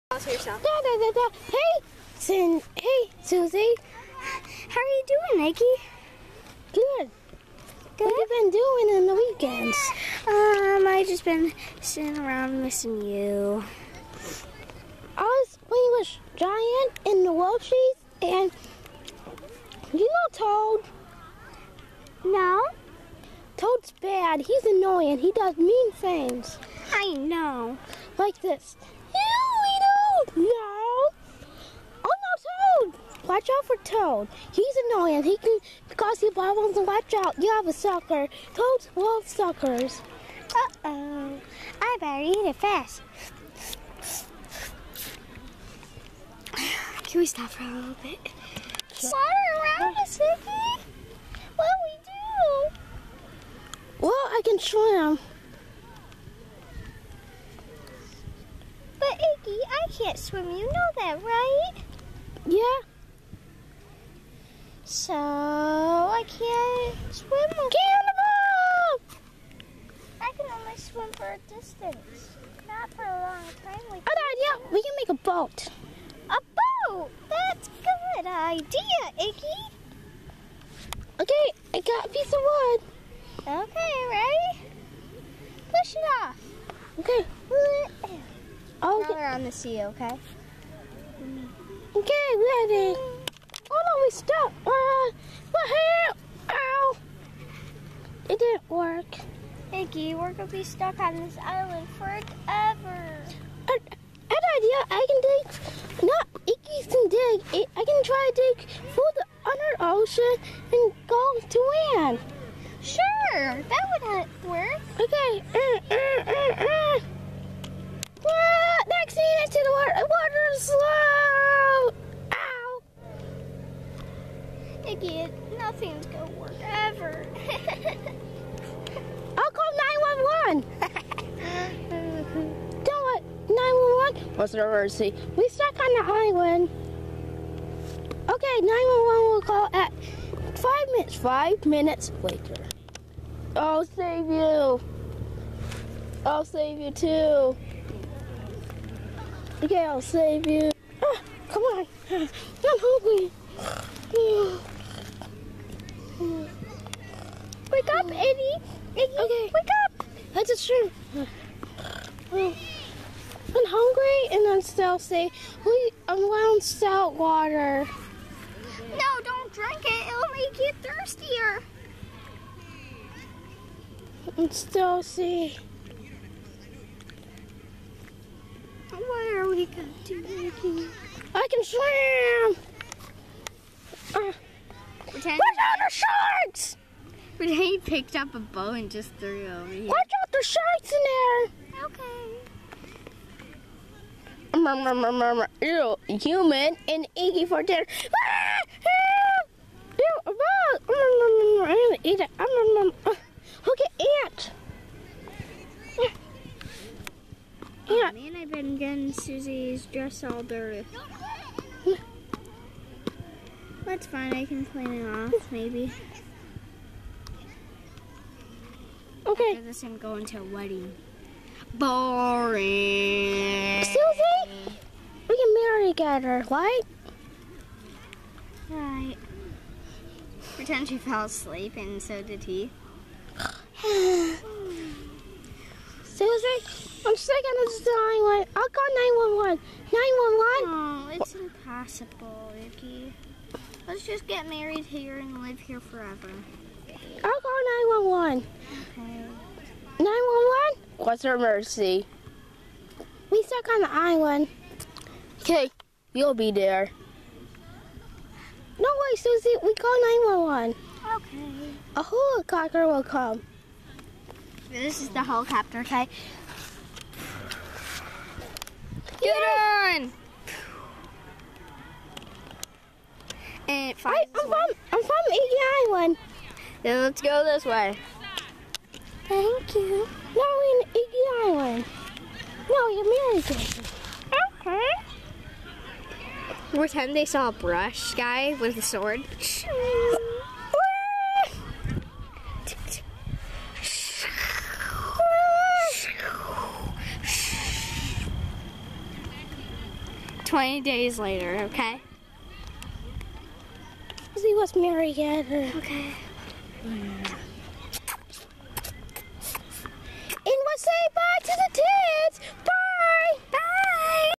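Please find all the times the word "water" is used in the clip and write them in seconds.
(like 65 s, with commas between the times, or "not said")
119 s, 167 s.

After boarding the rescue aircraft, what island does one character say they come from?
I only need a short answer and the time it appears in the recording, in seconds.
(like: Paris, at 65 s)
Eagle Island, at 275 s.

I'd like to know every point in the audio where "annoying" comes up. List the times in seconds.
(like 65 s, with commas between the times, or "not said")
24 s, 34 s.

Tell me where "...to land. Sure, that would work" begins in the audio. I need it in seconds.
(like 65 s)
111 s.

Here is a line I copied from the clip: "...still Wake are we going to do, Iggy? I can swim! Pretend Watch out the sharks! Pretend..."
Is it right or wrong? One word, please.
wrong.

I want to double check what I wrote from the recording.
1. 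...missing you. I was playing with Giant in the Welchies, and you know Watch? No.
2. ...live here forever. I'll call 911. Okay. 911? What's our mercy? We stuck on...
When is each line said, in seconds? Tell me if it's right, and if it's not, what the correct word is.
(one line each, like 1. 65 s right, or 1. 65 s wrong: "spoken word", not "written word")
1. 12 s wrong: "Toad", not "Watch"
2. 245 s right.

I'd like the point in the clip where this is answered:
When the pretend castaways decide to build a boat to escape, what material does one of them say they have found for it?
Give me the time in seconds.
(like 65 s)
82 s.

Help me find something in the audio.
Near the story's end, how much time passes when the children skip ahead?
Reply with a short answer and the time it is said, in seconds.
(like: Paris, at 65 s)
20 days, at 300 s.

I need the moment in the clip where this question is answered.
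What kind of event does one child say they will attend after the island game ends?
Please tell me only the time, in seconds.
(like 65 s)
220 s.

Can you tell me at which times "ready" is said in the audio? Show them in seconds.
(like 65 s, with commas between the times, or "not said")
84 s, 92 s.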